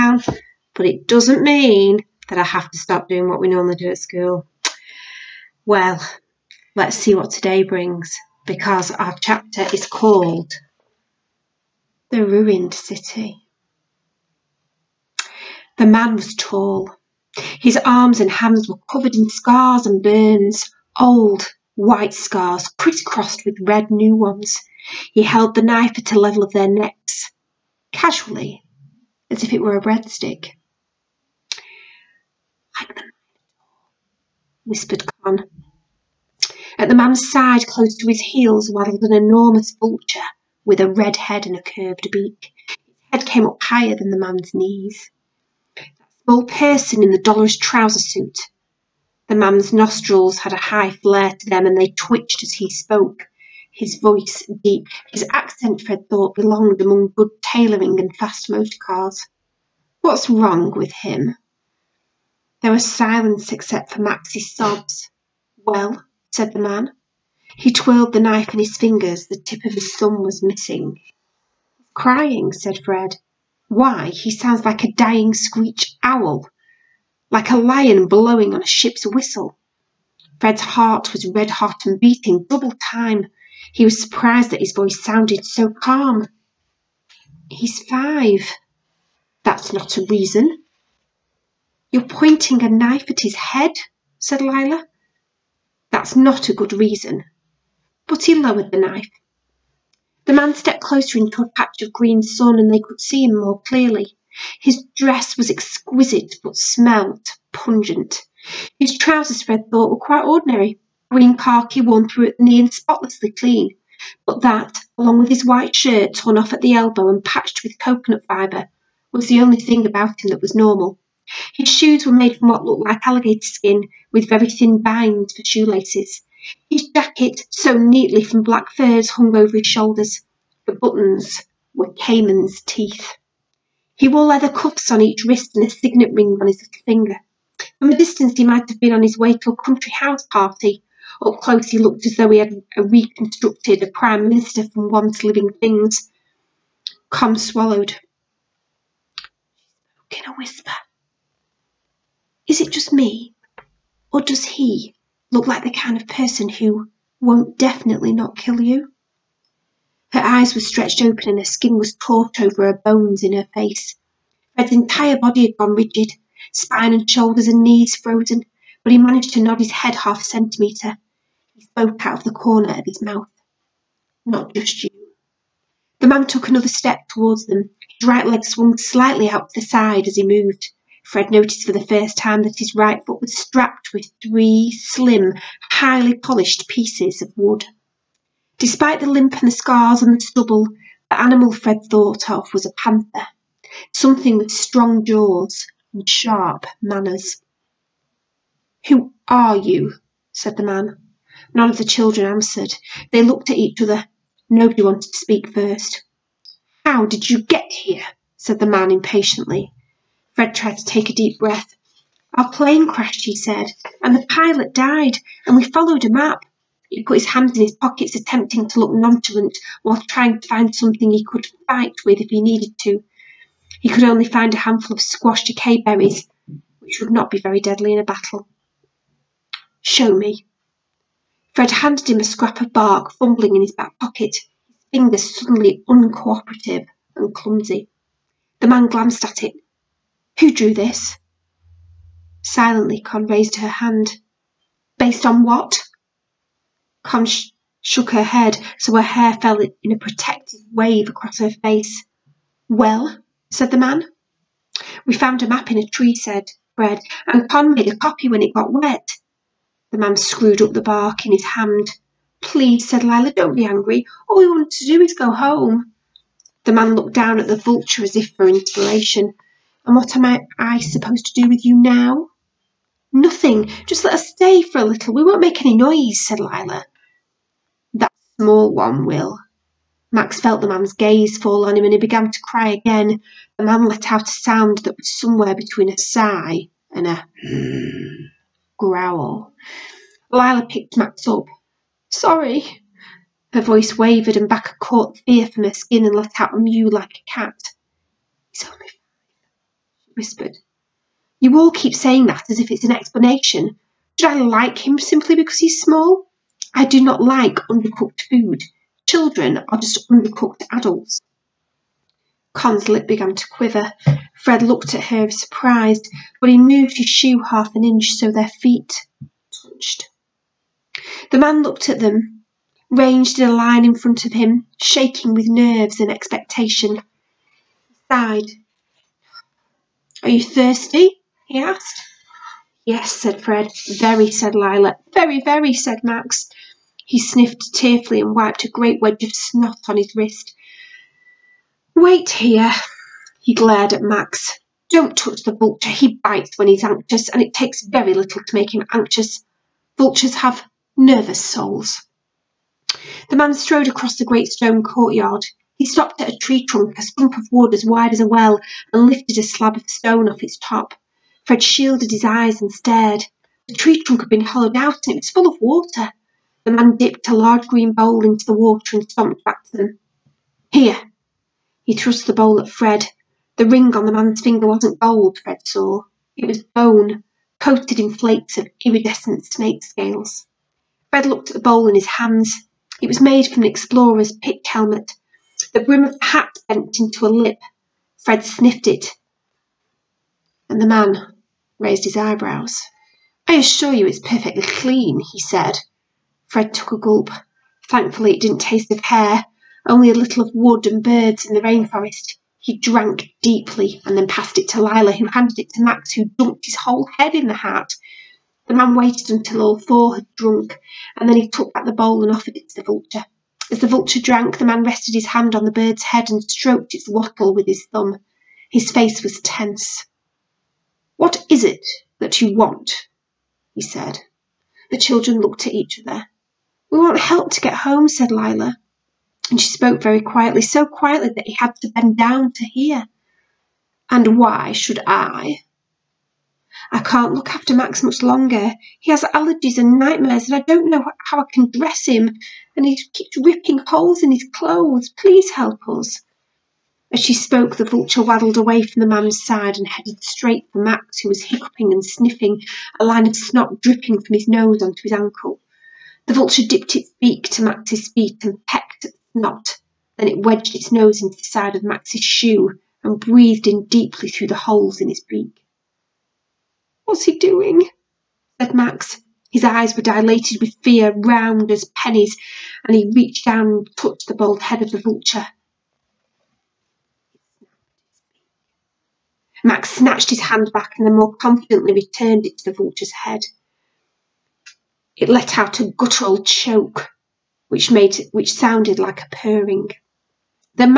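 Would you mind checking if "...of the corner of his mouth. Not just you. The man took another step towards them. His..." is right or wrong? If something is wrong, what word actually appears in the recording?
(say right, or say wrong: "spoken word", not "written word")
right.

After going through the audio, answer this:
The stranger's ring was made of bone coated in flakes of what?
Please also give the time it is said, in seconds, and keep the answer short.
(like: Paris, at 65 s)
snake scales, at 378 s.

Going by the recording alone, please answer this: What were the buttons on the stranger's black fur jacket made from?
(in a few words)
caiman's teeth.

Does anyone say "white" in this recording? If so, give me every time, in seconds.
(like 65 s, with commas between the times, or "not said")
21 s, 115 s.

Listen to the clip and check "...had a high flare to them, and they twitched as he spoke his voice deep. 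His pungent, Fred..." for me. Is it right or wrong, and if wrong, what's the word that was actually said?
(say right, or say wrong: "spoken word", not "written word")
wrong: "accent", not "pungent".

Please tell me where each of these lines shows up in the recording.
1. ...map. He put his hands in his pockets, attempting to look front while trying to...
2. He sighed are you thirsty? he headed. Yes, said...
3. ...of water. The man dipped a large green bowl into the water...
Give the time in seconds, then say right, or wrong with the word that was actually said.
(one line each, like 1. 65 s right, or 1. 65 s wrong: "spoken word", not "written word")
1. 216 s wrong: "nonchalant", not "front"
2. 326 s wrong: "asked", not "headed"
3. 365 s right.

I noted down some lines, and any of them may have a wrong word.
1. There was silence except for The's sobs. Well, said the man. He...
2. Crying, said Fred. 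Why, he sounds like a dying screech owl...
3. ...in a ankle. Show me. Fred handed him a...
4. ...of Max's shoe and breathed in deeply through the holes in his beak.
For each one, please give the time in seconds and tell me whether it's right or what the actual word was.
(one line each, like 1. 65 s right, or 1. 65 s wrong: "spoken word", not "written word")
1. 62 s wrong: "Max", not "The"
2. 71 s right
3. 227 s wrong: "battle", not "ankle"
4. 461 s right.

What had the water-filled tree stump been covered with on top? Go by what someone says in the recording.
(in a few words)
a slab of stone.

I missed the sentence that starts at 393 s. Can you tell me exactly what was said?
I assure you it's perfectly clean, he said.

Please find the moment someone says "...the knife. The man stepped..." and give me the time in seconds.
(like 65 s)
98 s.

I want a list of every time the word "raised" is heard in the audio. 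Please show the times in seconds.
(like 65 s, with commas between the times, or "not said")
243 s, 391 s.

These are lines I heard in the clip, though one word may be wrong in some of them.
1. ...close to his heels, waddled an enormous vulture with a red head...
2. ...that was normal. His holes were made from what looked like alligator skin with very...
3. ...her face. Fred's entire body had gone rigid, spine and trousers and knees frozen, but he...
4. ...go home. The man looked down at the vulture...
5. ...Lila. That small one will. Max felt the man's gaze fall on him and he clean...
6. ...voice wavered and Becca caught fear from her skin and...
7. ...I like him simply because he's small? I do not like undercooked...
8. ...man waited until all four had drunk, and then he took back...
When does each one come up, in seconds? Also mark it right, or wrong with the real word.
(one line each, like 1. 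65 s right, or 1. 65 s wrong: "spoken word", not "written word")
1. 37 s right
2. 120 s wrong: "shoes", not "holes"
3. 163 s wrong: "shoulders", not "trousers"
4. 265 s right
5. 276 s wrong: "began", not "clean"
6. 293 s right
7. 304 s right
8. 408 s right.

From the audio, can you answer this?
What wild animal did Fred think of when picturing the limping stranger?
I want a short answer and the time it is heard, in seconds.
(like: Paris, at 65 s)
panther, at 192 s.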